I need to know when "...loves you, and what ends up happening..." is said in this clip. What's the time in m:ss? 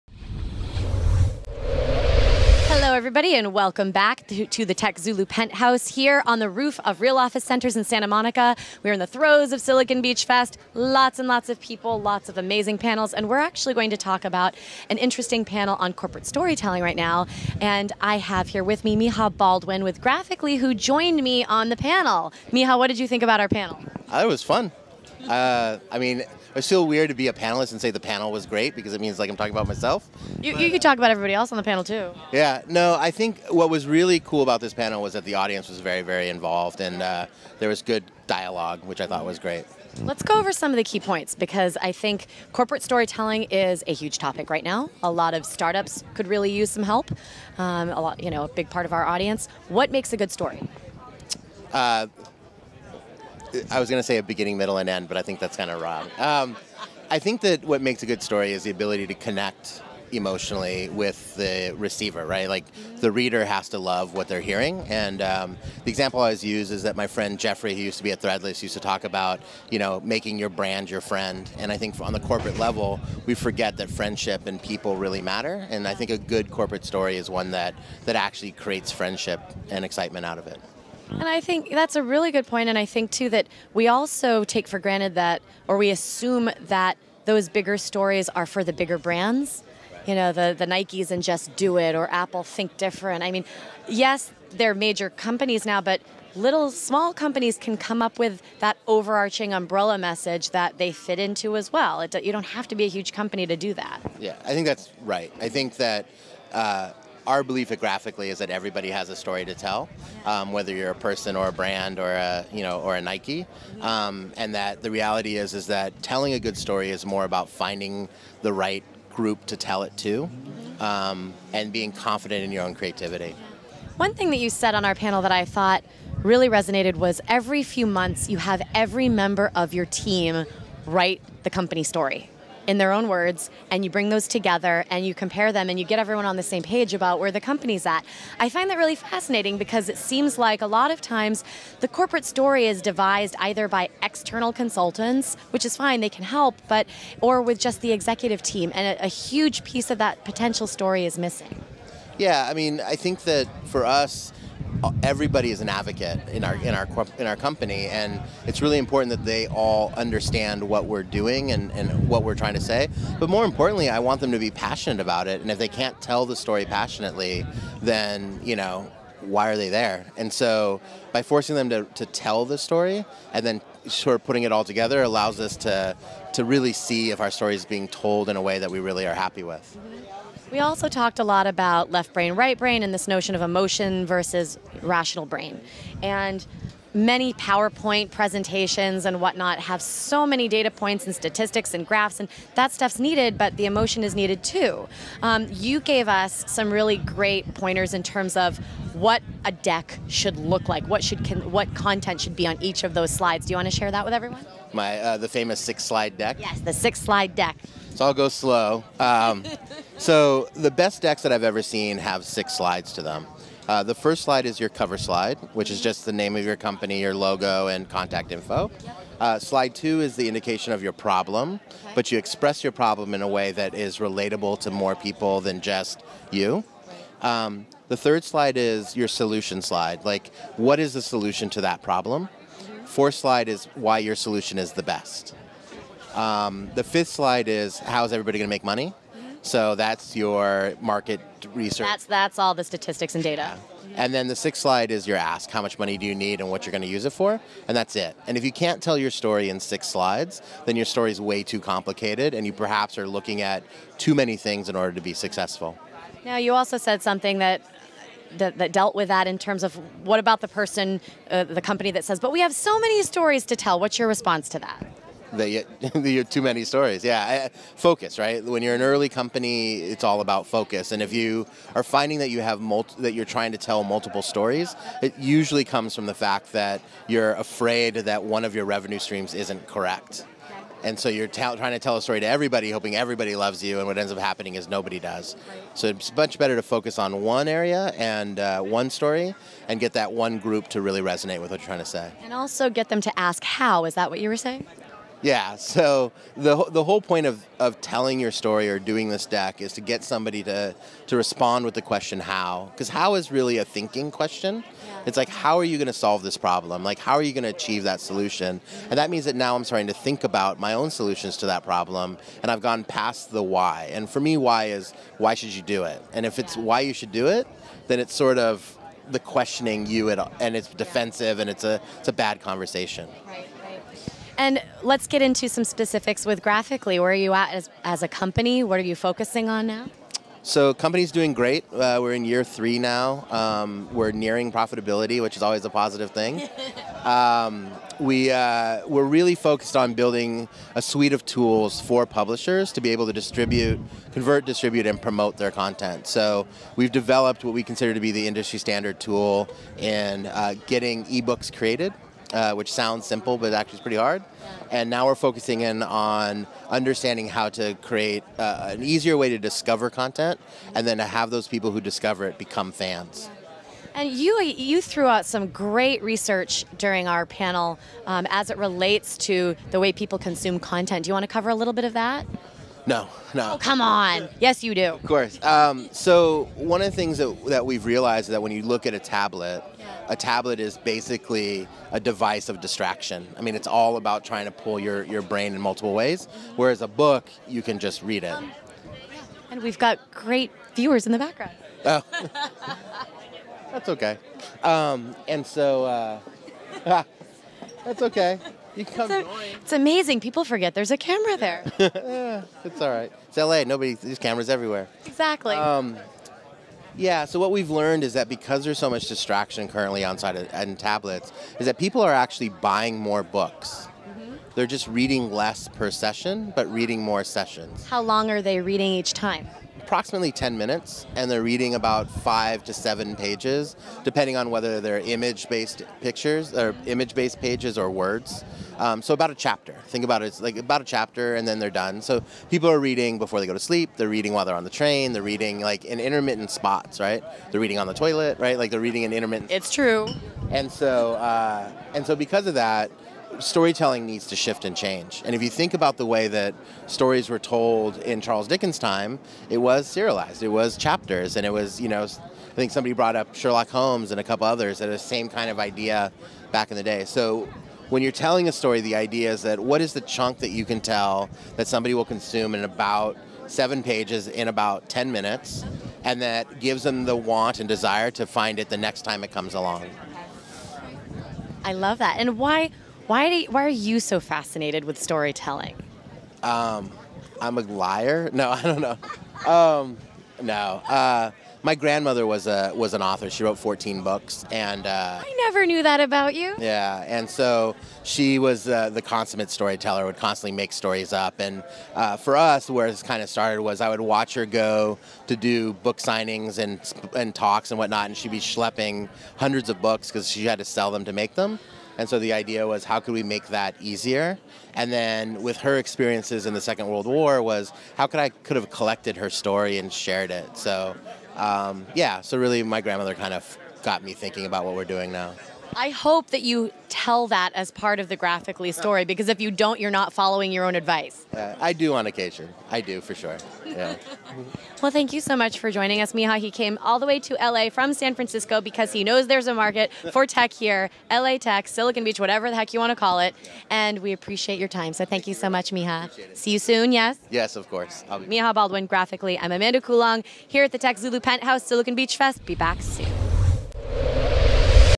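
4:43.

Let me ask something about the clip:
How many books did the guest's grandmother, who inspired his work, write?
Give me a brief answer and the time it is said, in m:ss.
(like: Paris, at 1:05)
14, at 8:03.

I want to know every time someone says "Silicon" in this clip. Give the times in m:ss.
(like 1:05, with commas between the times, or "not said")
0:09, 8:51, 9:01.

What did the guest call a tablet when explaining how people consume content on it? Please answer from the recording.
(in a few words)
a device of distraction.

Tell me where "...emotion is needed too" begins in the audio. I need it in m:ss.
3:13.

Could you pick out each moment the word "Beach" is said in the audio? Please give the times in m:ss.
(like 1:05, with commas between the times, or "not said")
0:10, 8:52, 9:01.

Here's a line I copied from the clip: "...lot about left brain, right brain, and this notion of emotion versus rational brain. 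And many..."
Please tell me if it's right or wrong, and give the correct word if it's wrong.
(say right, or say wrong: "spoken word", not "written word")
right.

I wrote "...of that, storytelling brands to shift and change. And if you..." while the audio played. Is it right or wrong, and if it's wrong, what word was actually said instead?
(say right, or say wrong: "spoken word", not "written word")
wrong: "needs", not "brands".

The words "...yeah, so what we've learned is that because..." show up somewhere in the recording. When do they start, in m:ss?
6:46.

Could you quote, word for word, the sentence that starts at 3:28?
Um, so the best decks that I've ever seen have six slides to them.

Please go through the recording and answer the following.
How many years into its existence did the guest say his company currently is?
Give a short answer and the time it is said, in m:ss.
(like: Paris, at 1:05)
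3, at 5:32.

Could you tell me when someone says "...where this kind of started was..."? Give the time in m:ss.
8:12.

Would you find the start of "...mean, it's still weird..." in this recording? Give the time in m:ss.
0:25.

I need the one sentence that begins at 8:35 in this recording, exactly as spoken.
I hope that you tell that as part of the Graphicly story because if you don't, you're not following your own advice.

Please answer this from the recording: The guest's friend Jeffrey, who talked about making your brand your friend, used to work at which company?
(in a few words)
Threadless.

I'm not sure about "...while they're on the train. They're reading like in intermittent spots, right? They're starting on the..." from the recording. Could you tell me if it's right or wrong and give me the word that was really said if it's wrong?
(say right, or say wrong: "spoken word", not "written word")
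wrong: "reading", not "starting".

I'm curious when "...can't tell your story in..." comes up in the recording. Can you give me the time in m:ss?
4:08.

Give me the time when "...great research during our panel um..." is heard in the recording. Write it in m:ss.
6:05.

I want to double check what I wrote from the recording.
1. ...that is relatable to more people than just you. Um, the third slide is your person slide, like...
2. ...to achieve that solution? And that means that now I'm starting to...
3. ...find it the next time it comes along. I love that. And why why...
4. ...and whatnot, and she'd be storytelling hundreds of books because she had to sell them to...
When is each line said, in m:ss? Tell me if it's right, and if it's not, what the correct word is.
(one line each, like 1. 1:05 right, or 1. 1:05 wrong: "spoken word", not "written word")
1. 3:43 wrong: "solution", not "person"
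2. 5:07 right
3. 7:48 right
4. 8:17 wrong: "schlepping", not "storytelling".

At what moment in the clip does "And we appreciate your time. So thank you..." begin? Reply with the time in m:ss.
8:53.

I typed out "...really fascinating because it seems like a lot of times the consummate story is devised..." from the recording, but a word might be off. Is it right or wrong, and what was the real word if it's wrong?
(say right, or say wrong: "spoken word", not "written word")
wrong: "corporate", not "consummate".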